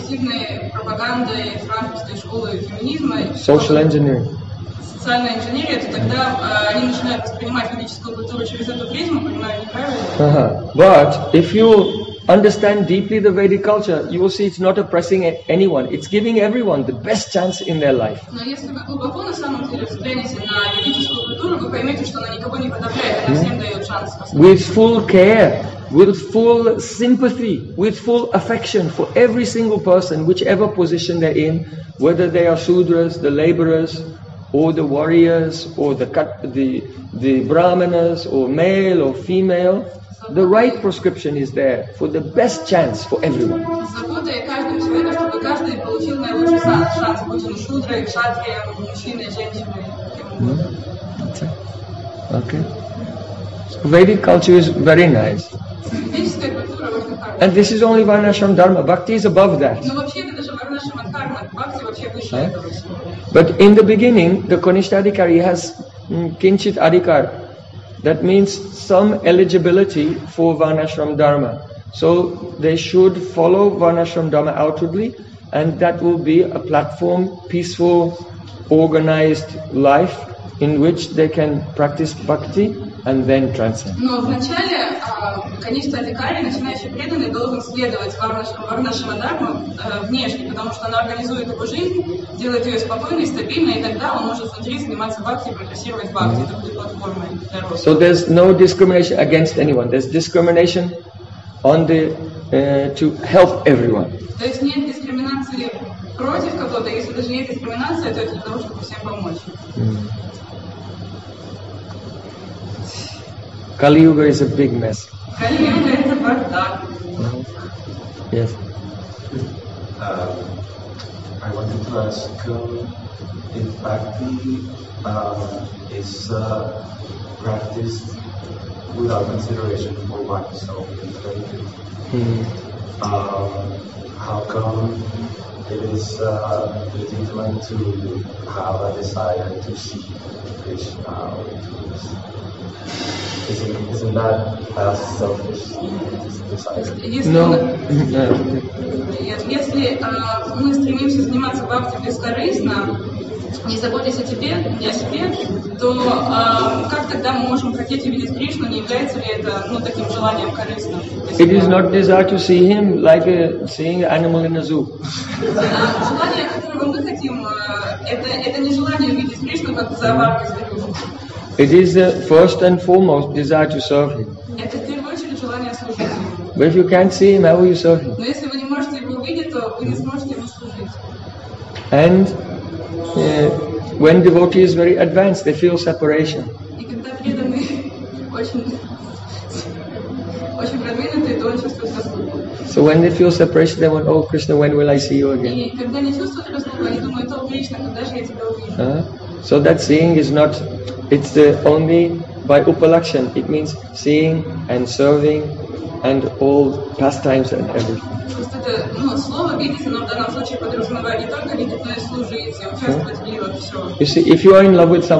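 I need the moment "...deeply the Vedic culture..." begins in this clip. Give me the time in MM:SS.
00:12.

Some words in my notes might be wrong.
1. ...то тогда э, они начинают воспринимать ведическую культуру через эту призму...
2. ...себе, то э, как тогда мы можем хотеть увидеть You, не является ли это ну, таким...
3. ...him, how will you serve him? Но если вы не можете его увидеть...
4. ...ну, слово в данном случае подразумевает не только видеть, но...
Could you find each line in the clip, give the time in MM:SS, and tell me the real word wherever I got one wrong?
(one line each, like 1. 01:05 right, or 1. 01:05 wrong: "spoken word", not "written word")
1. 00:05 right
2. 02:34 wrong: "Кришну", not "You"
3. 02:57 right
4. 03:28 right.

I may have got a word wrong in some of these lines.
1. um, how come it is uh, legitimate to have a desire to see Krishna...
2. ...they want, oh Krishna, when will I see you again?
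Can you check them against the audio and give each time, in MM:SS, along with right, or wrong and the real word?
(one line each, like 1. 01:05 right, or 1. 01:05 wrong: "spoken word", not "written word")
1. 02:13 right
2. 03:13 right.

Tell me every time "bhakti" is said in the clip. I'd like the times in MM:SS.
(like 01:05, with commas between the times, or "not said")
01:22, 02:03.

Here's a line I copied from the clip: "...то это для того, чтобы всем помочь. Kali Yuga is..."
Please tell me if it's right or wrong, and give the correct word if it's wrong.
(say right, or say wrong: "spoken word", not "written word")
right.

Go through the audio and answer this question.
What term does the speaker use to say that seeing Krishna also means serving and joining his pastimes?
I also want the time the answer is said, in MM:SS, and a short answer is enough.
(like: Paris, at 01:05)
upalakshan, at 03:22.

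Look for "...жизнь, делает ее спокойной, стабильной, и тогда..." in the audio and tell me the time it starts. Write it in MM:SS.
01:31.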